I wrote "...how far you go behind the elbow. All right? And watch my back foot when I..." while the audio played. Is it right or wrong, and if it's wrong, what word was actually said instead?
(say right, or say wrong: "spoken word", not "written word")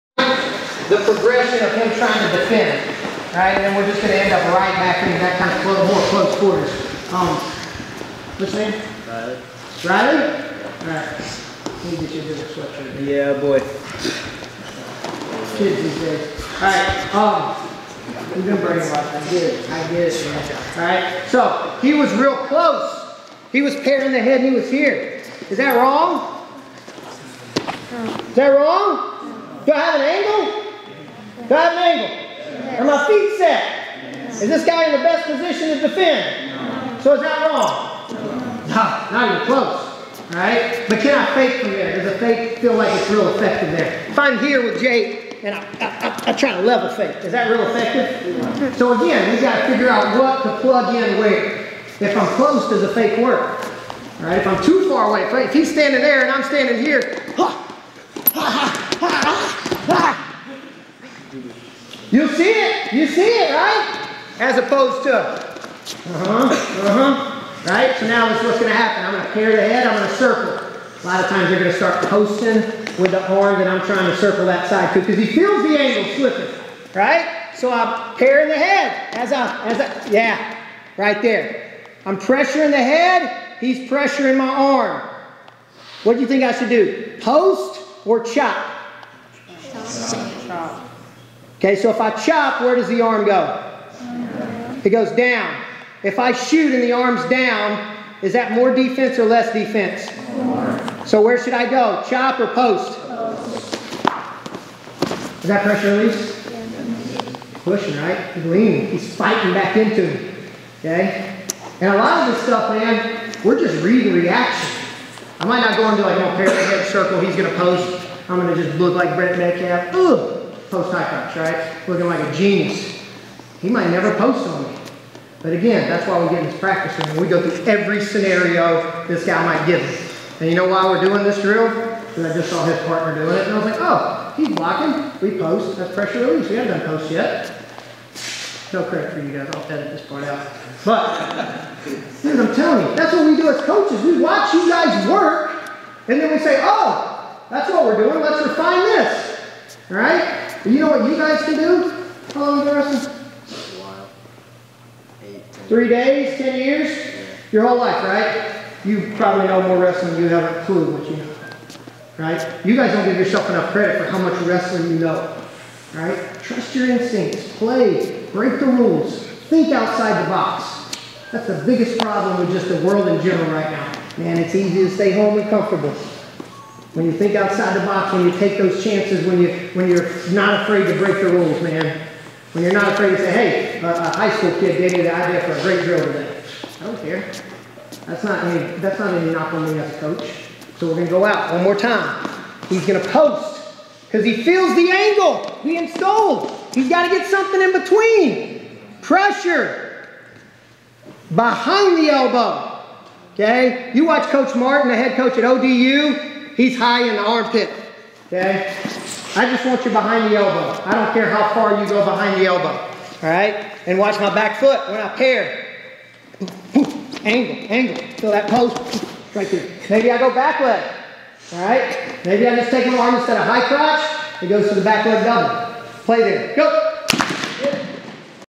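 right.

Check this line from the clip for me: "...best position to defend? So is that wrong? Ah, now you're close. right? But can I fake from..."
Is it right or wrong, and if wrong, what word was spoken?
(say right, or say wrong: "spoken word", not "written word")
right.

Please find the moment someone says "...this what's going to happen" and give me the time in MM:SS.
01:08.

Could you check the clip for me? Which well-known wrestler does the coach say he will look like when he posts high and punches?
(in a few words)
Brent Metcalf.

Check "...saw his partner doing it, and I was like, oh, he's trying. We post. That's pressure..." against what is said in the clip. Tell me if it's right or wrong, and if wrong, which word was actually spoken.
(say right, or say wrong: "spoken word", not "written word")
wrong: "blocking", not "trying".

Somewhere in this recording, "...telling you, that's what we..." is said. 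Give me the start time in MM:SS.
02:22.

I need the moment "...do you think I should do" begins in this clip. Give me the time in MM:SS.
01:26.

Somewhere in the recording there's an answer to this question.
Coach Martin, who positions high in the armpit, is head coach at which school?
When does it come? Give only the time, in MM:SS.
03:25.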